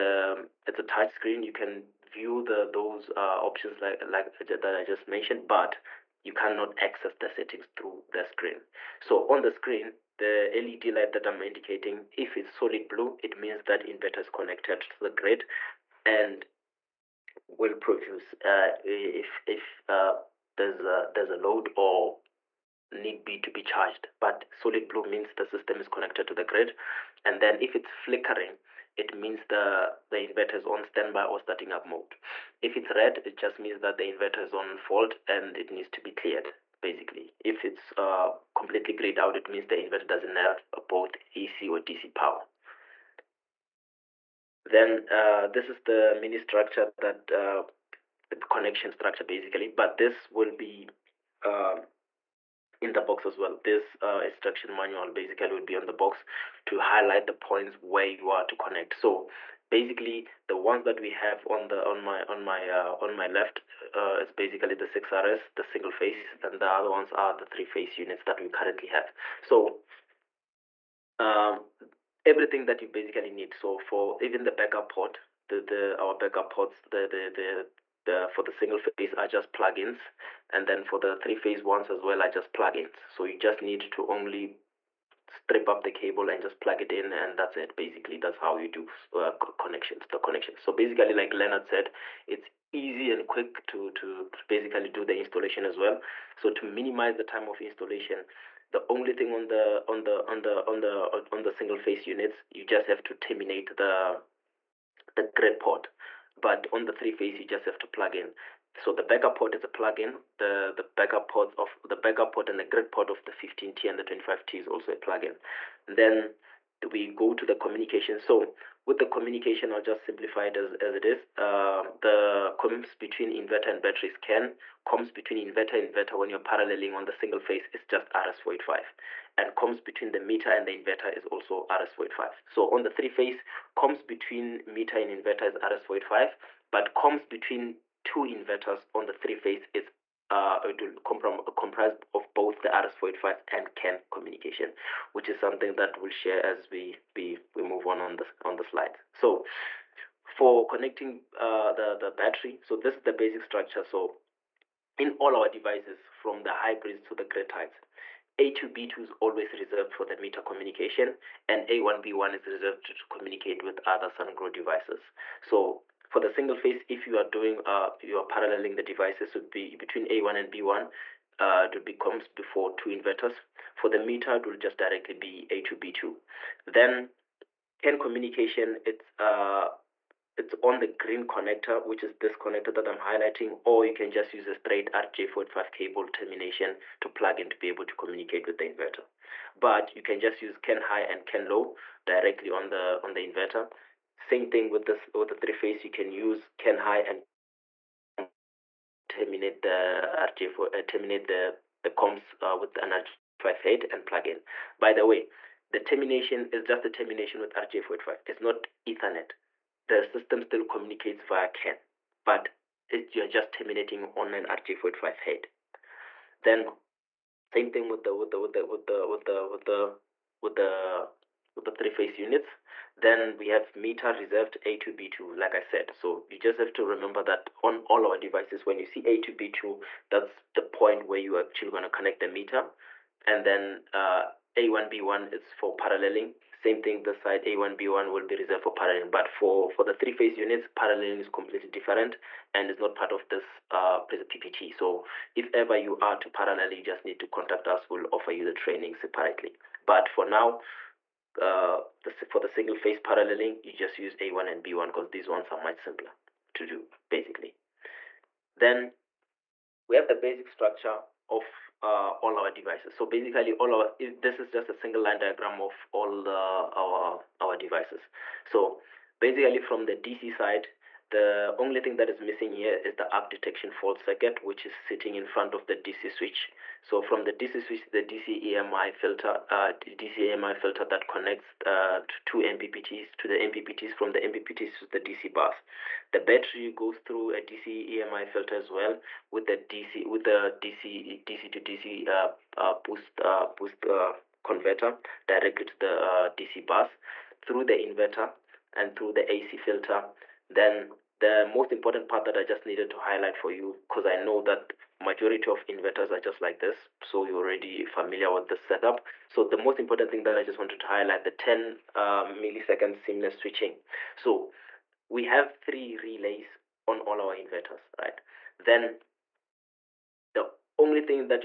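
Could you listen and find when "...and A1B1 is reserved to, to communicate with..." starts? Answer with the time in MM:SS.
02:41.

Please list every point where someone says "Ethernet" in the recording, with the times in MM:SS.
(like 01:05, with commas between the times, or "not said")
03:28.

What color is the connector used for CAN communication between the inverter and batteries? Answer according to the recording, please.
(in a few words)
Green.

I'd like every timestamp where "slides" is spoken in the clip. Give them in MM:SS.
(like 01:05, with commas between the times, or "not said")
02:28.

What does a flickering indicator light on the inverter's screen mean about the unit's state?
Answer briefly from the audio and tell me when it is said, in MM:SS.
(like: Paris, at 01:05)
Standby or starting up, at 00:30.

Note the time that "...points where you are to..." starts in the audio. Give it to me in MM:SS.
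00:57.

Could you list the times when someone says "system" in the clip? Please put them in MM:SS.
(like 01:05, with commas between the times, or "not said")
00:25, 03:30.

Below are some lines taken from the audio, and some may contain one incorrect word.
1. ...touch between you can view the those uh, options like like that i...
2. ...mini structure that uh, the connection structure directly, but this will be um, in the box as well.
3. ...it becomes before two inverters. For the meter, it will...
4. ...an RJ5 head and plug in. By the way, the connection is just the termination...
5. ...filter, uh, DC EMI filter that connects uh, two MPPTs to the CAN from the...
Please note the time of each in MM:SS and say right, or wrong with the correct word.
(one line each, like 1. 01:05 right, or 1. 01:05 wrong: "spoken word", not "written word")
1. 00:00 wrong: "screen", not "between"
2. 00:46 wrong: "basically", not "directly"
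3. 02:51 right
4. 03:22 wrong: "termination", not "connection"
5. 04:38 wrong: "MPPTs", not "CAN".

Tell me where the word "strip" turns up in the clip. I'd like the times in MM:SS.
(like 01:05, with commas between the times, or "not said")
01:25.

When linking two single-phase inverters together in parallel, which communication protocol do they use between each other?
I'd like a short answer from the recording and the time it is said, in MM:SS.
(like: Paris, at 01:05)
RS485, at 02:04.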